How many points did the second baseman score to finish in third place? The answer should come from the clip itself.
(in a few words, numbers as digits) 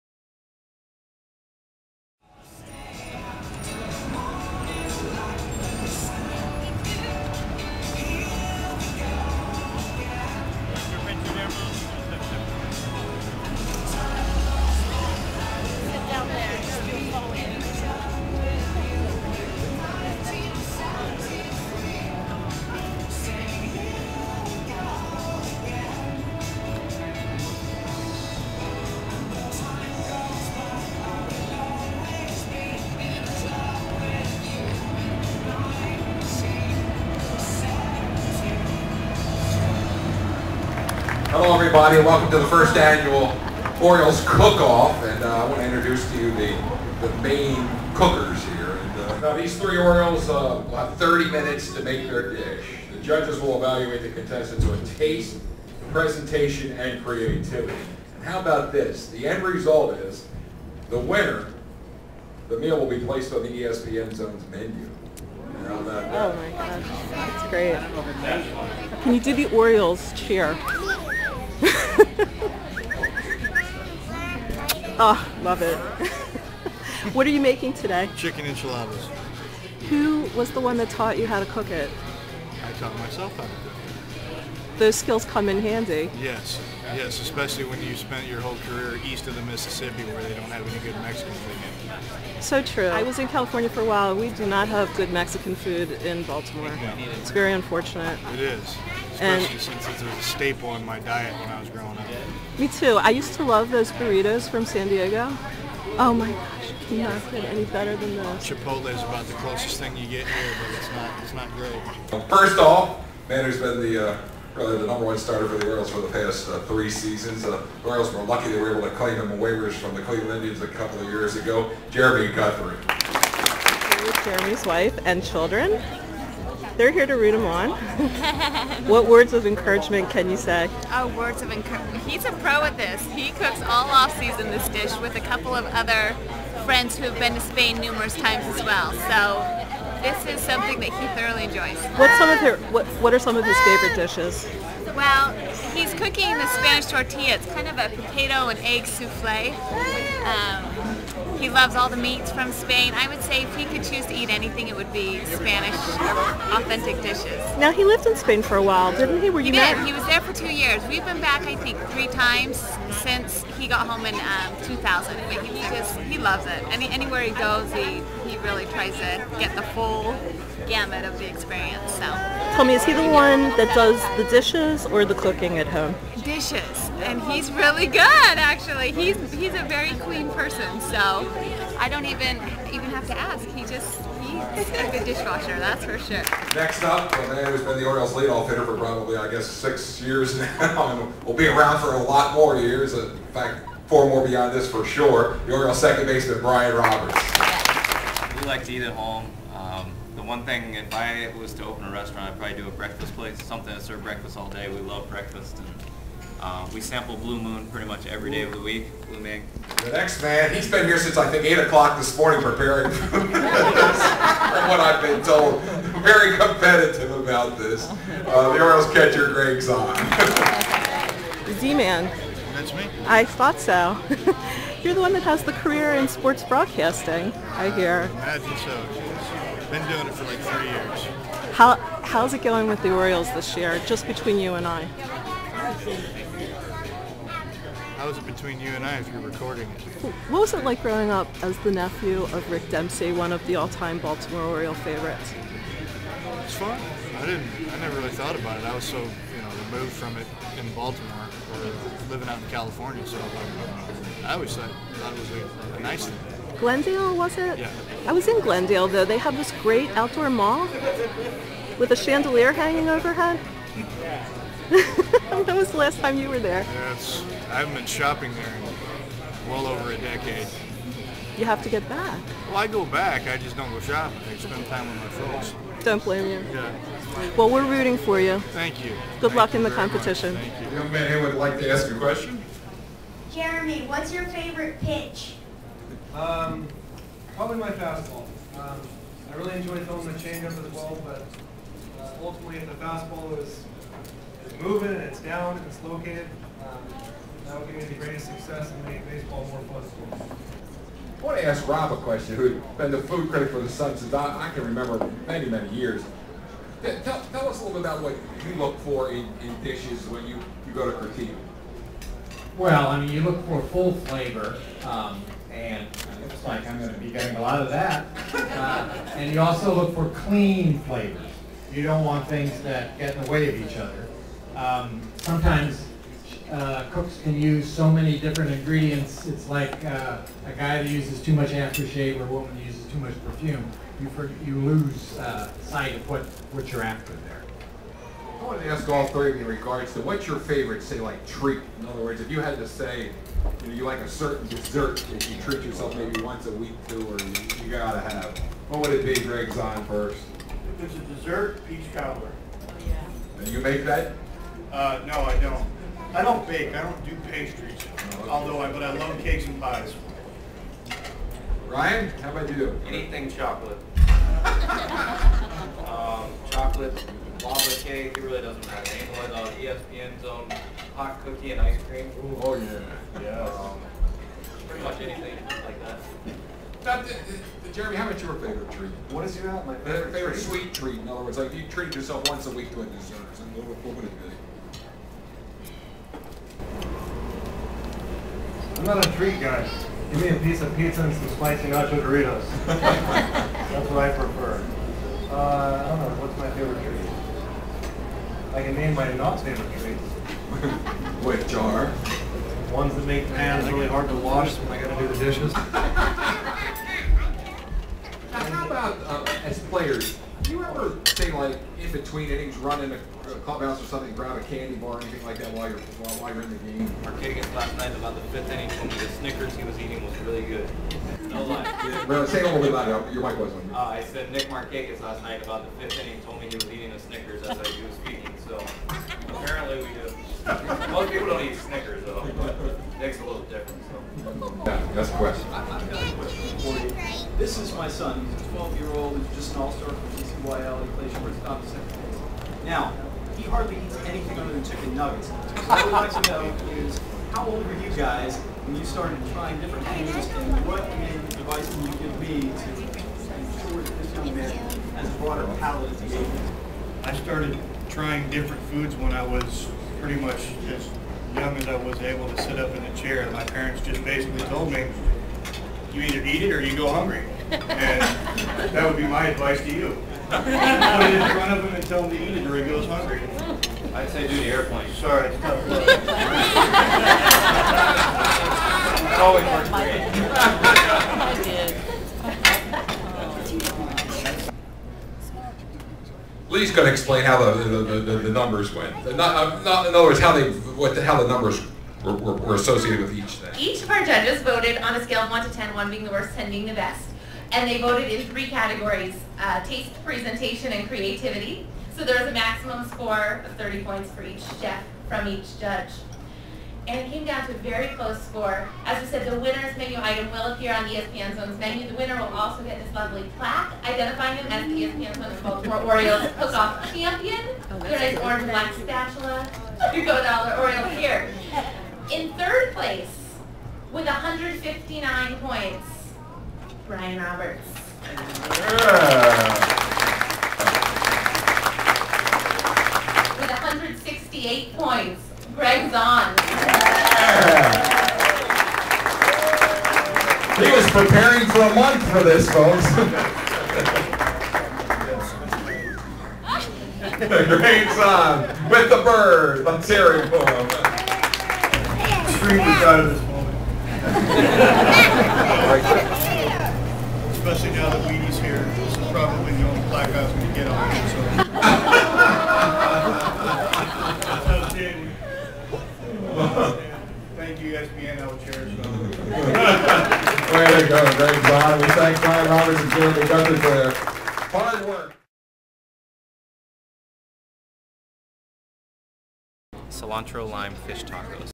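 159.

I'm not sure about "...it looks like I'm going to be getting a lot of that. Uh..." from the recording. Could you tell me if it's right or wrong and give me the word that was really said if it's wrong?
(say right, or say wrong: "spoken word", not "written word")
right.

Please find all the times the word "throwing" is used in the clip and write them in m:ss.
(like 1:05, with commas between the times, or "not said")
4:49.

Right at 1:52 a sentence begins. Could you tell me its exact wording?
First off, Mander's been the uh, really the number one starter for the Orioles for the past uh, three seasons.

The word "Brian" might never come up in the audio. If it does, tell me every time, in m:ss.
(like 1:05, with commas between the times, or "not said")
3:16, 6:01, 8:46, 9:32.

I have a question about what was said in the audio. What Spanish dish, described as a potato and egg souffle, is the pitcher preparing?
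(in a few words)
Spanish tortilla.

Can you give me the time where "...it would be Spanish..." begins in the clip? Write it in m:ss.
2:34.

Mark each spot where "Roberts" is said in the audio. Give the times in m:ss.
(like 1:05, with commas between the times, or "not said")
3:16, 8:47, 9:32.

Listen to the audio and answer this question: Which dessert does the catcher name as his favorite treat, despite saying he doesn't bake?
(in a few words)
Peach cobbler.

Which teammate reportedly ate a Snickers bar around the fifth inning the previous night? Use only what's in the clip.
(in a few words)
Nick Markakis.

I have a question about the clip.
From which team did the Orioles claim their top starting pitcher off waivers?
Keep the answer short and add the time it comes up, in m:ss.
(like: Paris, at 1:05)
Cleveland Indians, at 2:00.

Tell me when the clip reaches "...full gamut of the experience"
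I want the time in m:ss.
2:49.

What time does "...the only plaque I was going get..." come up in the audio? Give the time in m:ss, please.
9:19.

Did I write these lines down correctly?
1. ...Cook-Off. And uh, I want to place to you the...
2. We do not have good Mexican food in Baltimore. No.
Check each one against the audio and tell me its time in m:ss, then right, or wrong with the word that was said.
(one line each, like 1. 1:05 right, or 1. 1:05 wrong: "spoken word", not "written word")
1. 0:44 wrong: "introduce", not "place"
2. 1:34 right.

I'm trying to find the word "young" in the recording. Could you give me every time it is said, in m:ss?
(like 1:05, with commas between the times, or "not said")
4:40, 7:34, 7:41.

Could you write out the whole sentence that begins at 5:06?
Tell, tell, us a little bit about what you look for in, in dishes when you, you go to critique.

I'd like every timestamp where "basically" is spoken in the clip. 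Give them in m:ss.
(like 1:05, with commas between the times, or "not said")
7:44.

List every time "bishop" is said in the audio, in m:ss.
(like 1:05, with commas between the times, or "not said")
not said.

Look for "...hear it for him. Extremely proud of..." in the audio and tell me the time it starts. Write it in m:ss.
9:09.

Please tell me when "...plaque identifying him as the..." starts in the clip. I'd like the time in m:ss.
8:33.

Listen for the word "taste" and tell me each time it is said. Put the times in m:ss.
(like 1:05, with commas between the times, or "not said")
0:54, 8:19.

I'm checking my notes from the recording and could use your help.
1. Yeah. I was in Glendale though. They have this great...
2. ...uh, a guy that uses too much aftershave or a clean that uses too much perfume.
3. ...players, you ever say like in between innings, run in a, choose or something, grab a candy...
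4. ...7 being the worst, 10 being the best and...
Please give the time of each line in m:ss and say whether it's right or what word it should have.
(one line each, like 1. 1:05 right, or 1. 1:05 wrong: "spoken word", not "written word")
1. 4:17 right
2. 5:29 wrong: "woman", not "clean"
3. 6:49 wrong: "clubhouse", not "choose"
4. 8:15 wrong: "1", not "7".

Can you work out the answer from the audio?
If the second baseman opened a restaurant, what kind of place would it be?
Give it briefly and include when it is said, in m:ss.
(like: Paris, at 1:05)
A breakfast place, at 3:22.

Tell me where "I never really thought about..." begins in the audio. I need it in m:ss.
4:07.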